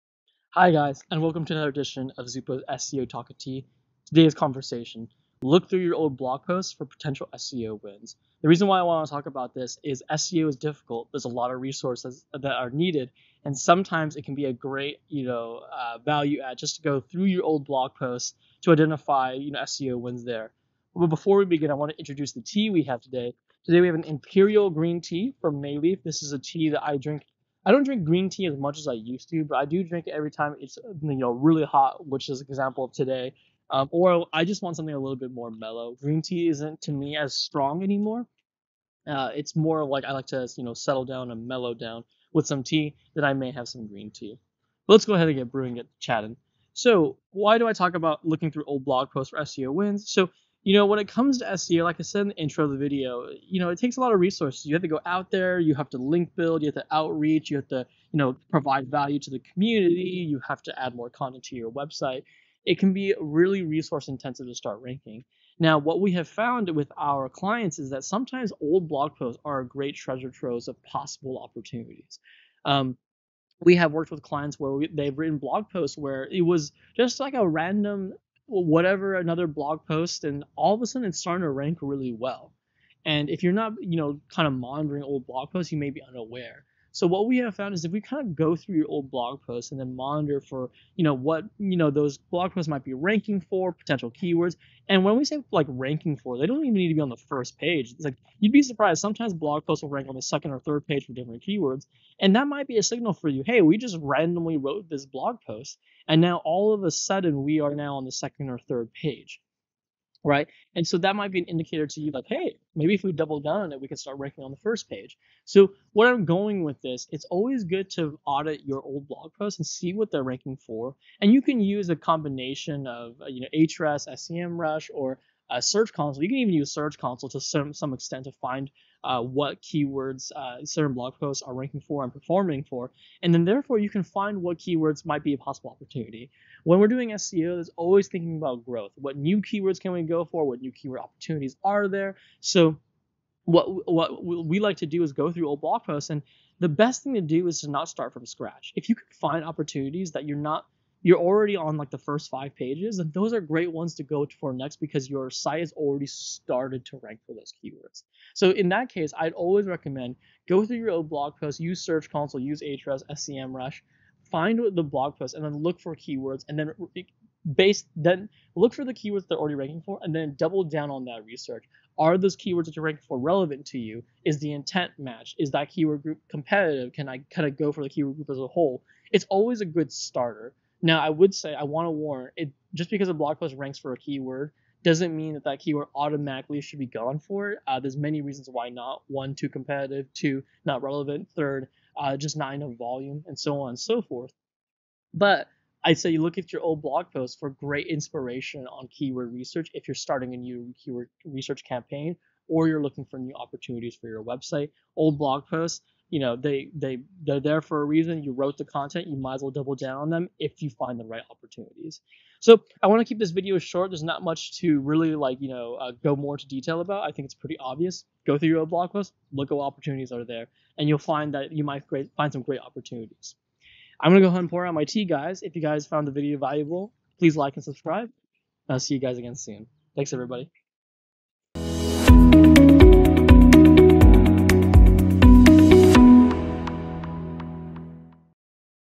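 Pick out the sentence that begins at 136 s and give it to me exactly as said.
When we're doing SEO, there's always thinking about growth.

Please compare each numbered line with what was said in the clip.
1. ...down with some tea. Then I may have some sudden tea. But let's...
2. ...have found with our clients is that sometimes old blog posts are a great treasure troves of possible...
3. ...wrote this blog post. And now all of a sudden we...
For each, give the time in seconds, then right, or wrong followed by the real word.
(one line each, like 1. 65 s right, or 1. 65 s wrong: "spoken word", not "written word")
1. 41 s wrong: "green", not "sudden"
2. 66 s right
3. 104 s right.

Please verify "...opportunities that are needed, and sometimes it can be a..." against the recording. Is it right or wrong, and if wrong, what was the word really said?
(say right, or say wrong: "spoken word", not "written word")
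wrong: "resources", not "opportunities".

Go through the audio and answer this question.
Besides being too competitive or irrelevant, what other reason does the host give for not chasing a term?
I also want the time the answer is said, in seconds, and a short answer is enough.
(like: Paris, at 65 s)
Not enough volume, at 192 s.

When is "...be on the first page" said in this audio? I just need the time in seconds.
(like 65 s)
96 s.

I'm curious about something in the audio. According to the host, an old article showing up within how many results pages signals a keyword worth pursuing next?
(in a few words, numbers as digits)
5.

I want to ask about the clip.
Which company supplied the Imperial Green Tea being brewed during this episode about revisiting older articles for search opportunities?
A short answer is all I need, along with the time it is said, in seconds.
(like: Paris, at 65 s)
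Mei Leaf, at 25 s.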